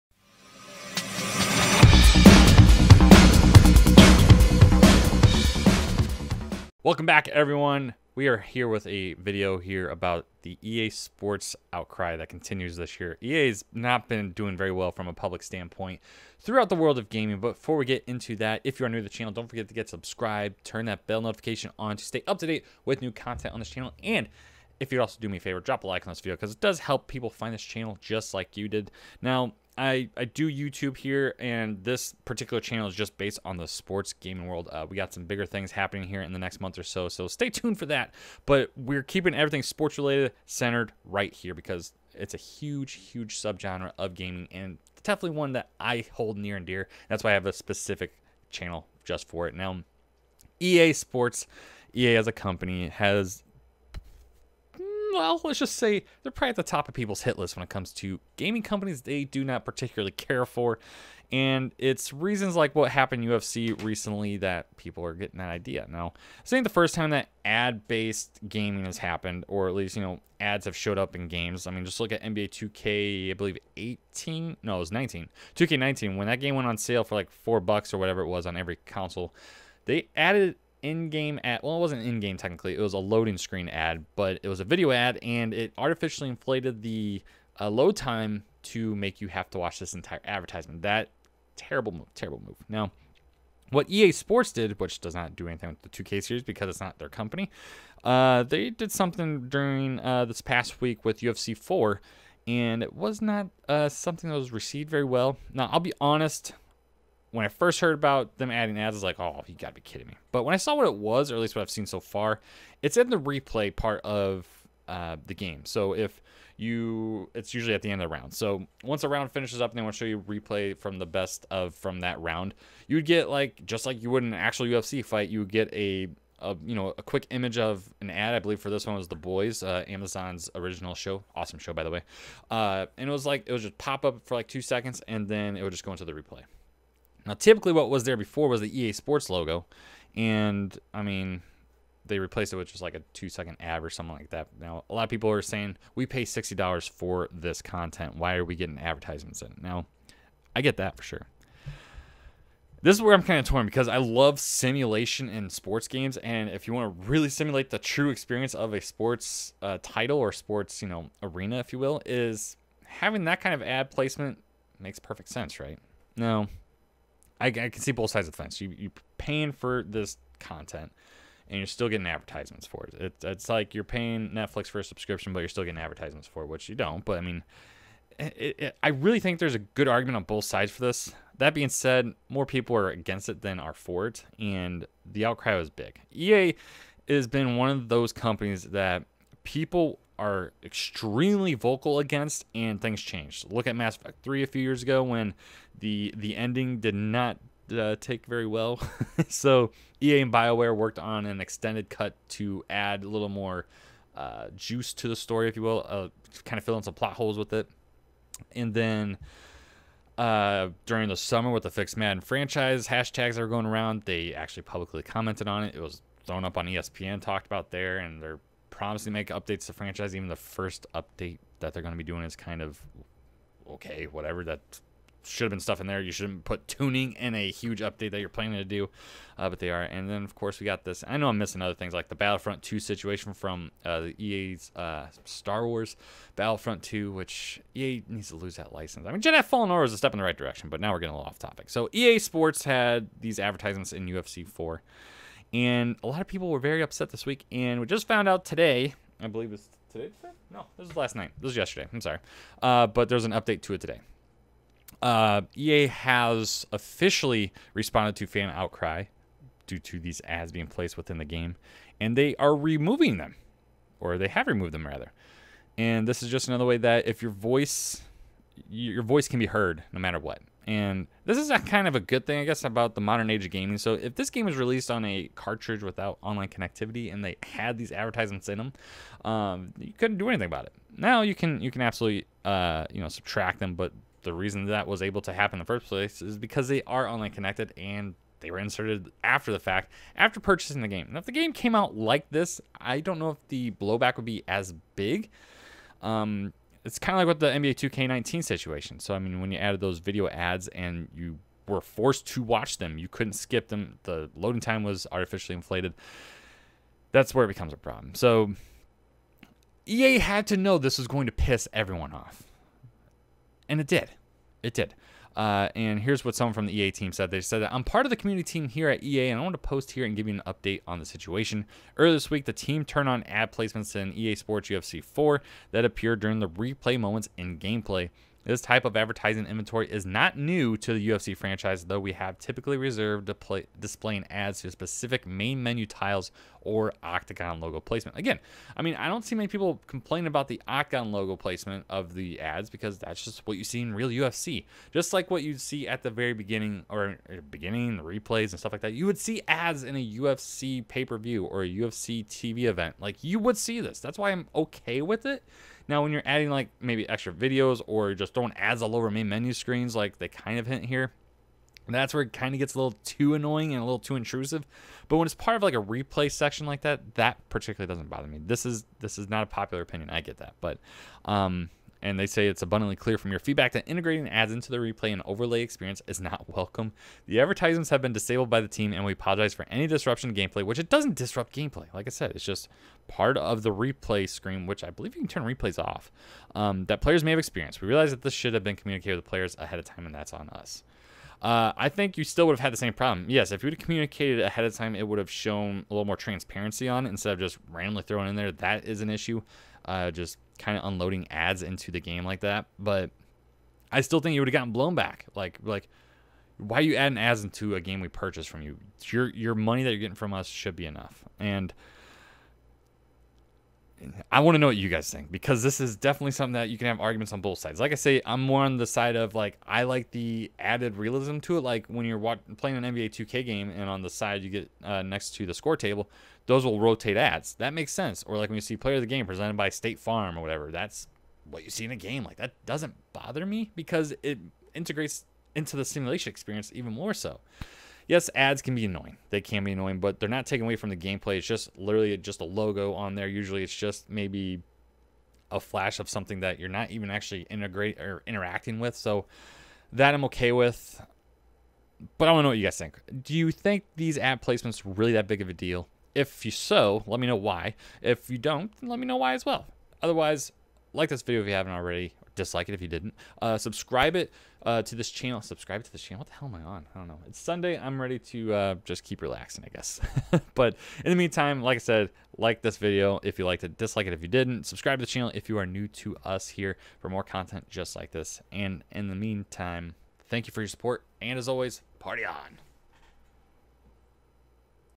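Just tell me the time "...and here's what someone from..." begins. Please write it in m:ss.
5:15.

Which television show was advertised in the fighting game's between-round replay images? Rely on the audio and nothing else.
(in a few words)
The Boys.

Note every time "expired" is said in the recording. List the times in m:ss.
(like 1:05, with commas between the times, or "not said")
not said.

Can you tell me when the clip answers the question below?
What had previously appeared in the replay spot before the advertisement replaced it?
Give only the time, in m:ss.
2:18.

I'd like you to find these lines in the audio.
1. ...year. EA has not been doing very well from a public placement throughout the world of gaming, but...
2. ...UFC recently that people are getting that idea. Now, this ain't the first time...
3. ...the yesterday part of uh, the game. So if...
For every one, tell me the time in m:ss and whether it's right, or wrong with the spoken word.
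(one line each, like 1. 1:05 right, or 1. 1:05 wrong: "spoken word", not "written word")
1. 0:12 wrong: "standpoint", not "placement"
2. 1:03 right
3. 1:53 wrong: "replay", not "yesterday".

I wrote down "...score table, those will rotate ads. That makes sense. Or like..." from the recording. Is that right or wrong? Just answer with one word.
right.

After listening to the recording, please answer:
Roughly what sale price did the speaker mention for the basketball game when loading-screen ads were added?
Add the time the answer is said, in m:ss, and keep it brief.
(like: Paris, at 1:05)
$4, at 1:17.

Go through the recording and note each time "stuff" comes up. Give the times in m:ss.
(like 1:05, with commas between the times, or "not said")
3:45, 5:48.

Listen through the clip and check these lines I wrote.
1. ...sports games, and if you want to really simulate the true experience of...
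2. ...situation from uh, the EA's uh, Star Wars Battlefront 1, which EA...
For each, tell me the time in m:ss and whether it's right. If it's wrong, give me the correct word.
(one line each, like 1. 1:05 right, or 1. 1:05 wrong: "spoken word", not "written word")
1. 2:35 right
2. 3:52 wrong: "2", not "1".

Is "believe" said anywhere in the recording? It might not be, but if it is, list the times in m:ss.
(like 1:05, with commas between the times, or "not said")
1:13, 2:08, 4:09, 6:24.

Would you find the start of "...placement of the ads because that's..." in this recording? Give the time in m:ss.
5:41.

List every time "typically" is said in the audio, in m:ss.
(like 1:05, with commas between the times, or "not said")
2:17, 5:32.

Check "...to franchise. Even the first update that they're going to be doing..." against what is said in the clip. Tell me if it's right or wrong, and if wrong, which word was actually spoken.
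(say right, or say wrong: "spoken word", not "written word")
right.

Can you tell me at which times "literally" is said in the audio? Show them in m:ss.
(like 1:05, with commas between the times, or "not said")
7:21.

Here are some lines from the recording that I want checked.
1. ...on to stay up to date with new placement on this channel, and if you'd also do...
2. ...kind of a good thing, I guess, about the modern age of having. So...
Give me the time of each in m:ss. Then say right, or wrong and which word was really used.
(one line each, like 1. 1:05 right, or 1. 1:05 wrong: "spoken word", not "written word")
1. 0:21 wrong: "content", not "placement"
2. 4:31 wrong: "gaming", not "having".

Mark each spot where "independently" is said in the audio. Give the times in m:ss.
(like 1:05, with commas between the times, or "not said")
not said.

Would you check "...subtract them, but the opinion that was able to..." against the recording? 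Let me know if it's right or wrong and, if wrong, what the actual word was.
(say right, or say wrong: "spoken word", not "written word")
wrong: "reason", not "opinion".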